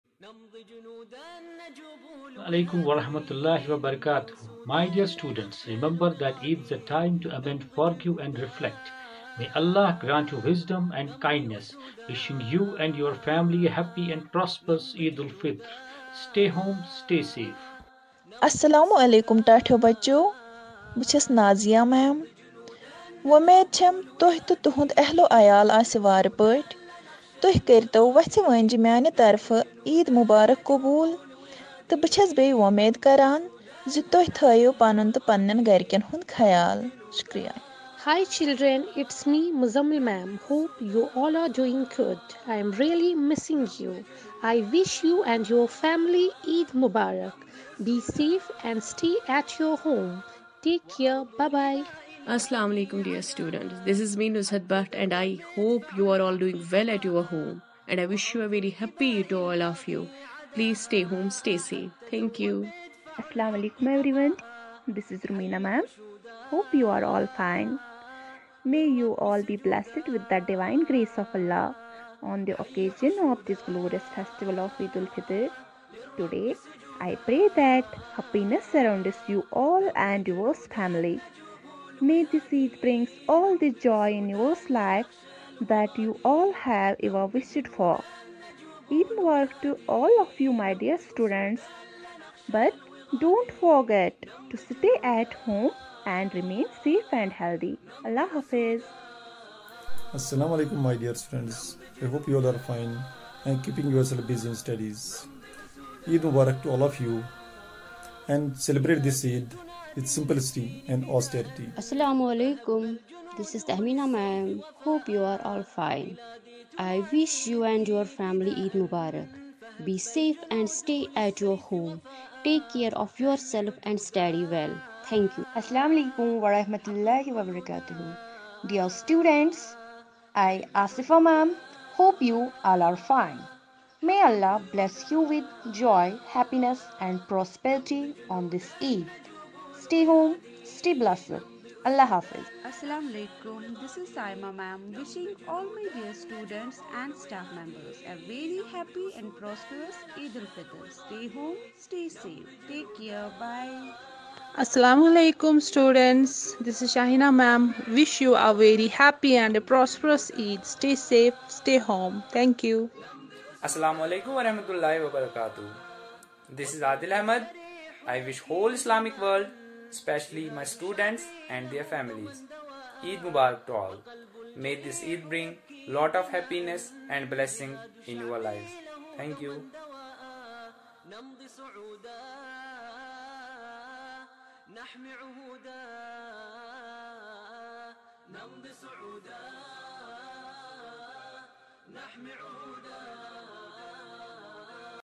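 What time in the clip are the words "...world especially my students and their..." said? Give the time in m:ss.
2:49.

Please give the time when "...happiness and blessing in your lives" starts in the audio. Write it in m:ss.
2:56.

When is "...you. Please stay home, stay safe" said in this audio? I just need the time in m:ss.
0:59.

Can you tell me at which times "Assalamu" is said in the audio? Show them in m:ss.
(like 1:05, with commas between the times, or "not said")
0:52, 1:03, 1:40, 1:51, 2:05, 2:22, 2:34, 2:43.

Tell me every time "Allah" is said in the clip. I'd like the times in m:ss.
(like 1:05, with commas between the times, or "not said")
1:11, 1:38, 2:14, 2:21.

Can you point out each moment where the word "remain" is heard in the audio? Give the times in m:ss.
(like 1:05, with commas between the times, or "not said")
1:36.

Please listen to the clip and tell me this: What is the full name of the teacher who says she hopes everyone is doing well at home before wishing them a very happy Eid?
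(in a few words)
Nusrat Bhatt.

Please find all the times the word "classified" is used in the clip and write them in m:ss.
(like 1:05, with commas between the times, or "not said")
not said.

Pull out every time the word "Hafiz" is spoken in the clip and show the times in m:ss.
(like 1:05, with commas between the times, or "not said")
1:38, 2:22.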